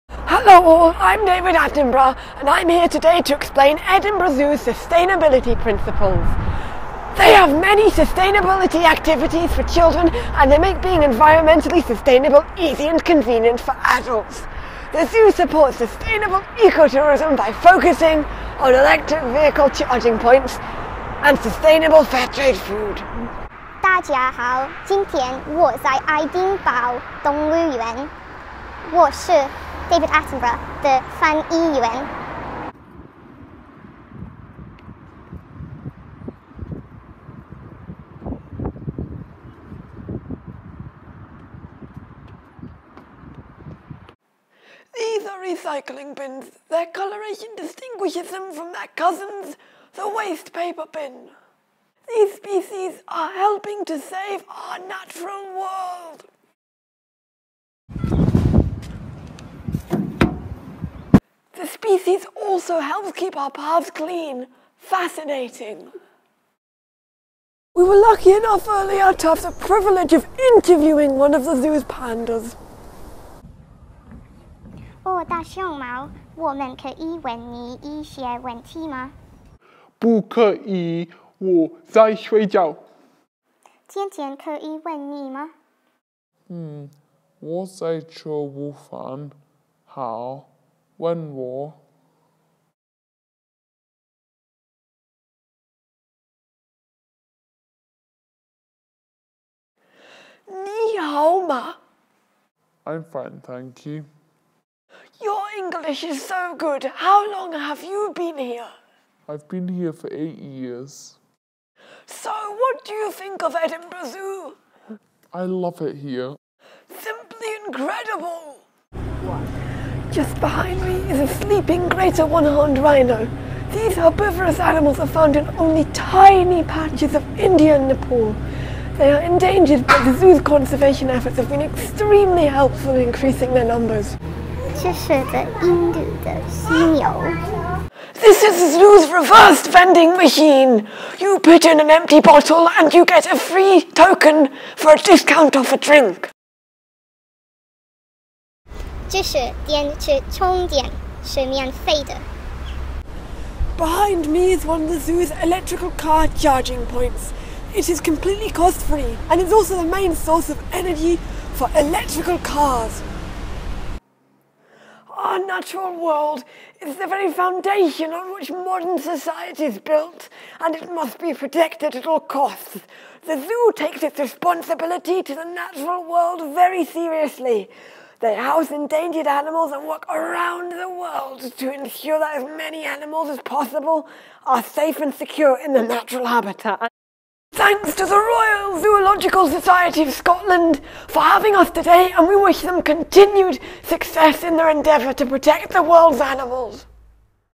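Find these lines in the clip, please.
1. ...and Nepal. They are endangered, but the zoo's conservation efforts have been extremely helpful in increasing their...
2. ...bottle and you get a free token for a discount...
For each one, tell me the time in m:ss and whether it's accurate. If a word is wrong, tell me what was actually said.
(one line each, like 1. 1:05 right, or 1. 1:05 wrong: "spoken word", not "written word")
1. 2:07 right
2. 2:22 right.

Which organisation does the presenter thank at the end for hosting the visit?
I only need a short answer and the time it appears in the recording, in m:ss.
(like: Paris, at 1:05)
Royal Zoological Society of Scotland, at 3:08.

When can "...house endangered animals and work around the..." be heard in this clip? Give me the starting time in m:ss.
2:58.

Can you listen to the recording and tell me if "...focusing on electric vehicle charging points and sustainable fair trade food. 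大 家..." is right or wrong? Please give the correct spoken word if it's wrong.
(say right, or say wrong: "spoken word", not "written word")
right.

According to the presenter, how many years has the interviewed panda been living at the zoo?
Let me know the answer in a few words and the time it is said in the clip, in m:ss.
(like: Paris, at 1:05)
8, at 1:50.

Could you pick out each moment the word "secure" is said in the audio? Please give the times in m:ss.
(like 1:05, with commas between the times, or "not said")
3:05.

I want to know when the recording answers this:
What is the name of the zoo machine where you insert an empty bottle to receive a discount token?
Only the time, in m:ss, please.
2:19.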